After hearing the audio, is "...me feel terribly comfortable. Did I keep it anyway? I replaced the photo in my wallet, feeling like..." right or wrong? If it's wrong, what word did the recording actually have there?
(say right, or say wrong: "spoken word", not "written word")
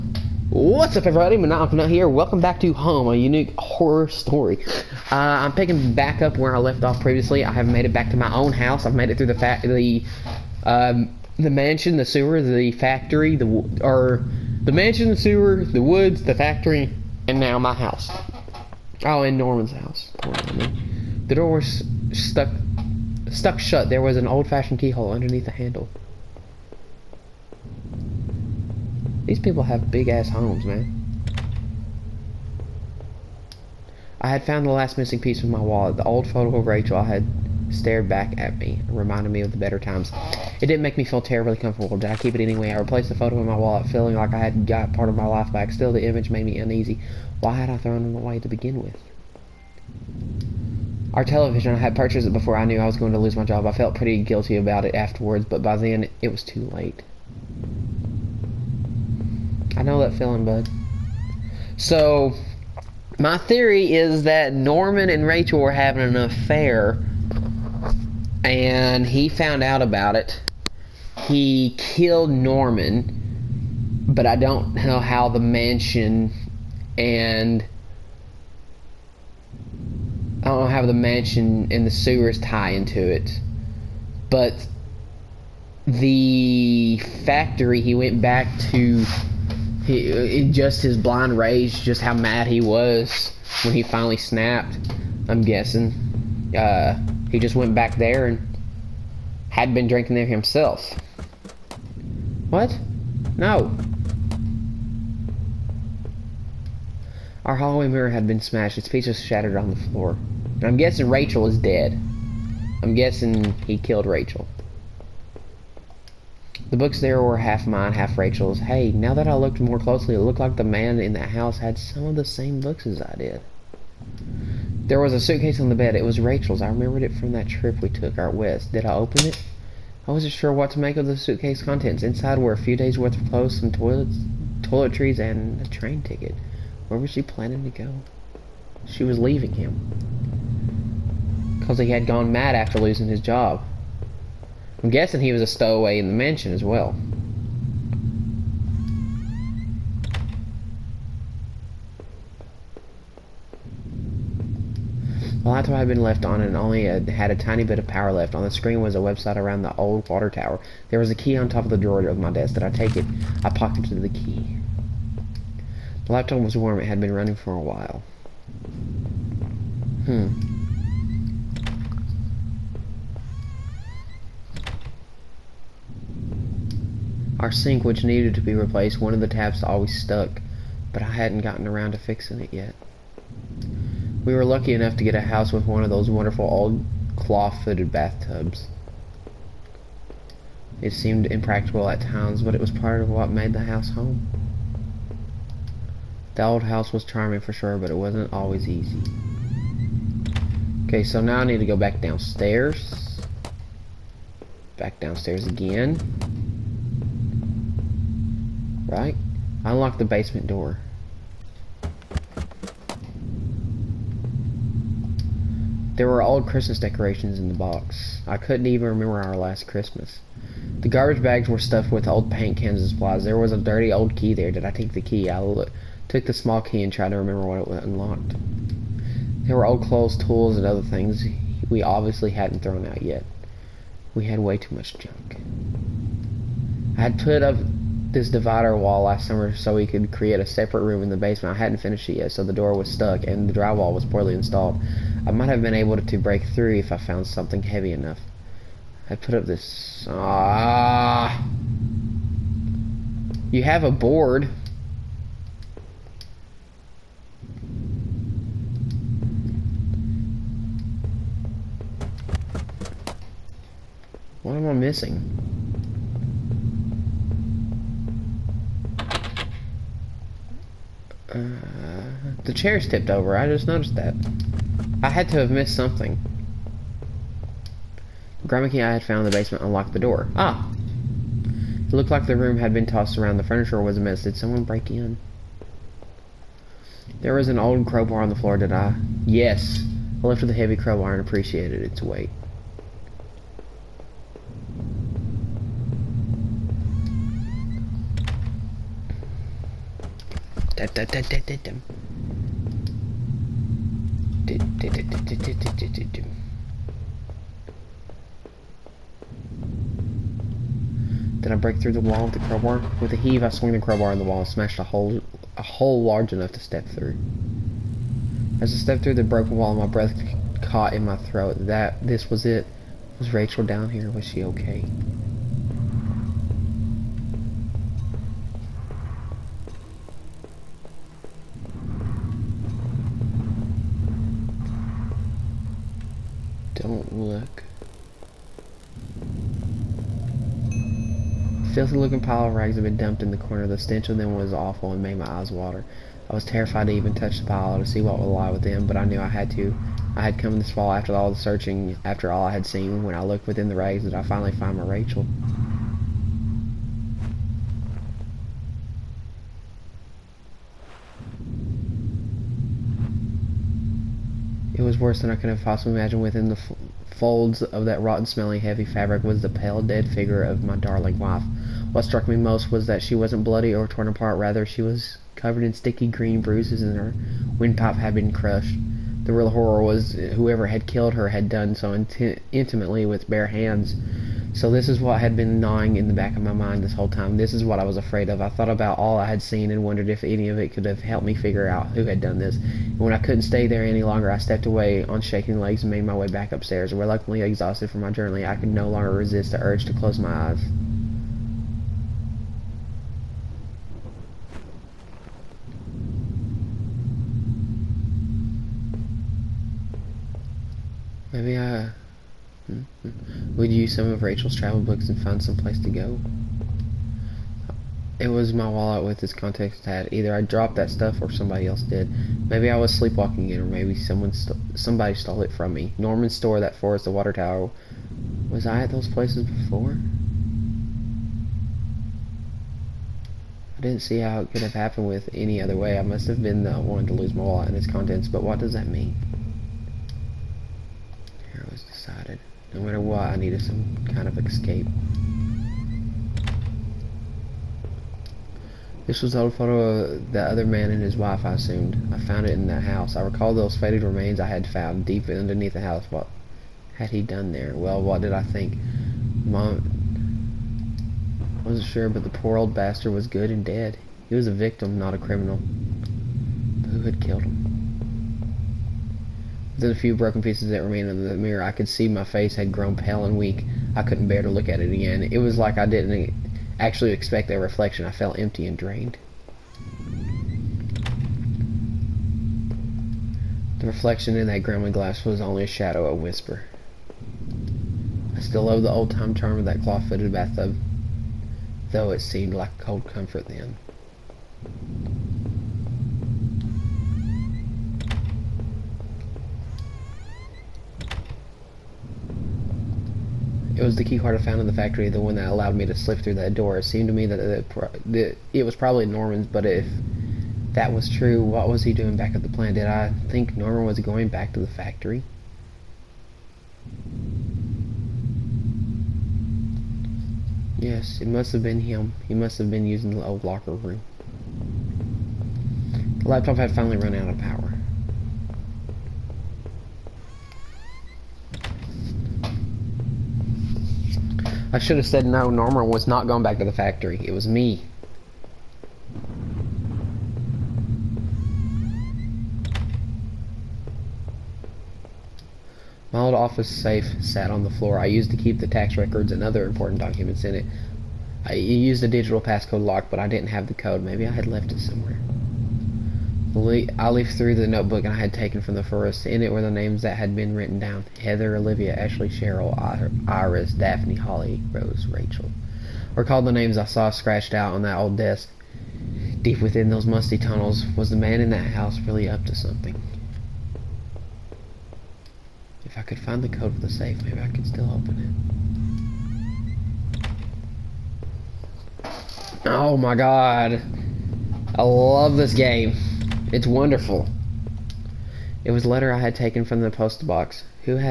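right.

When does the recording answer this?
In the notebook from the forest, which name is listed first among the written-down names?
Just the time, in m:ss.
9:21.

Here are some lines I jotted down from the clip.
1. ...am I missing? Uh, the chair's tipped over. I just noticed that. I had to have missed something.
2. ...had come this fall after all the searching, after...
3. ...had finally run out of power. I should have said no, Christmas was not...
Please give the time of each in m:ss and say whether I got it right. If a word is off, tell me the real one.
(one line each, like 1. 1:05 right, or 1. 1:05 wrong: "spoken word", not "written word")
1. 4:24 right
2. 5:50 right
3. 8:46 wrong: "Norman", not "Christmas".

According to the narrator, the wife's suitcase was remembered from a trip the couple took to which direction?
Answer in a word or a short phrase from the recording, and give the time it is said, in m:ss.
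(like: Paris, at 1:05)
Out west, at 2:08.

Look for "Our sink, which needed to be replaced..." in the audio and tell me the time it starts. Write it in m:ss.
2:57.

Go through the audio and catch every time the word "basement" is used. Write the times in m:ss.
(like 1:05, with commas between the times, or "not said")
3:30, 4:01, 4:39.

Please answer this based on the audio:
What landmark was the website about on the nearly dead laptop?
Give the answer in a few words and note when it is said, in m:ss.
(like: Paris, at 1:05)
The old water tower, at 2:39.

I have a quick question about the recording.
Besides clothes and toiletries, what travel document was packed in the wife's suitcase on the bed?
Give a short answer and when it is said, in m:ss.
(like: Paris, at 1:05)
A train ticket, at 2:15.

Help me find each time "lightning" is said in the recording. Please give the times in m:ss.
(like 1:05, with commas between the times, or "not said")
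not said.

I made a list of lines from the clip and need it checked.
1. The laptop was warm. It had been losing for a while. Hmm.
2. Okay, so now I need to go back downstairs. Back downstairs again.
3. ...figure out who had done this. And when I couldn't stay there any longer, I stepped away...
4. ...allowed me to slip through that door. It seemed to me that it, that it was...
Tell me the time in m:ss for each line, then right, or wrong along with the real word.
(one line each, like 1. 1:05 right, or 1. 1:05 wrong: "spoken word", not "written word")
1. 2:46 wrong: "running", not "losing"
2. 3:20 right
3. 6:31 right
4. 8:25 right.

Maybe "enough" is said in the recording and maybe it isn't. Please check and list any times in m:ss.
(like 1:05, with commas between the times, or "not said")
3:04, 4:07, 5:16.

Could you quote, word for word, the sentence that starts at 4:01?
I hadn't finished it yet, so the door was stuck and the drywall was poorly installed.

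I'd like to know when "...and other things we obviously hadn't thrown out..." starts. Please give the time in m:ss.
3:50.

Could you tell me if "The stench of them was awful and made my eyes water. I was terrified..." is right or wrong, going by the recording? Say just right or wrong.
right.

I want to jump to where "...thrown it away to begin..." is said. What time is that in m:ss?
0:47.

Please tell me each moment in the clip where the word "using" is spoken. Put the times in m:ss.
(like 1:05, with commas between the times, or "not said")
8:42.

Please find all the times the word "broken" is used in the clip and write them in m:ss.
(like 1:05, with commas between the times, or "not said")
5:19, 7:50.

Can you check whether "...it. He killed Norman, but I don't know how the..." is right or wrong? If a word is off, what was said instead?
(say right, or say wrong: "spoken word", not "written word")
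right.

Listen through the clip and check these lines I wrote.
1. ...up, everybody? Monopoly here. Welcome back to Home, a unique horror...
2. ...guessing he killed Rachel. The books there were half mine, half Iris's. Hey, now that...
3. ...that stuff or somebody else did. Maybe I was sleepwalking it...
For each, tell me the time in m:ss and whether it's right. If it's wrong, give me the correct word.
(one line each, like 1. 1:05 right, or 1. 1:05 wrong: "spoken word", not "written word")
1. 0:00 right
2. 1:52 wrong: "Rachel", not "Iris"
3. 7:00 right.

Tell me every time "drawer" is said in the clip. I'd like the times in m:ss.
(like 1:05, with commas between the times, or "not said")
2:41.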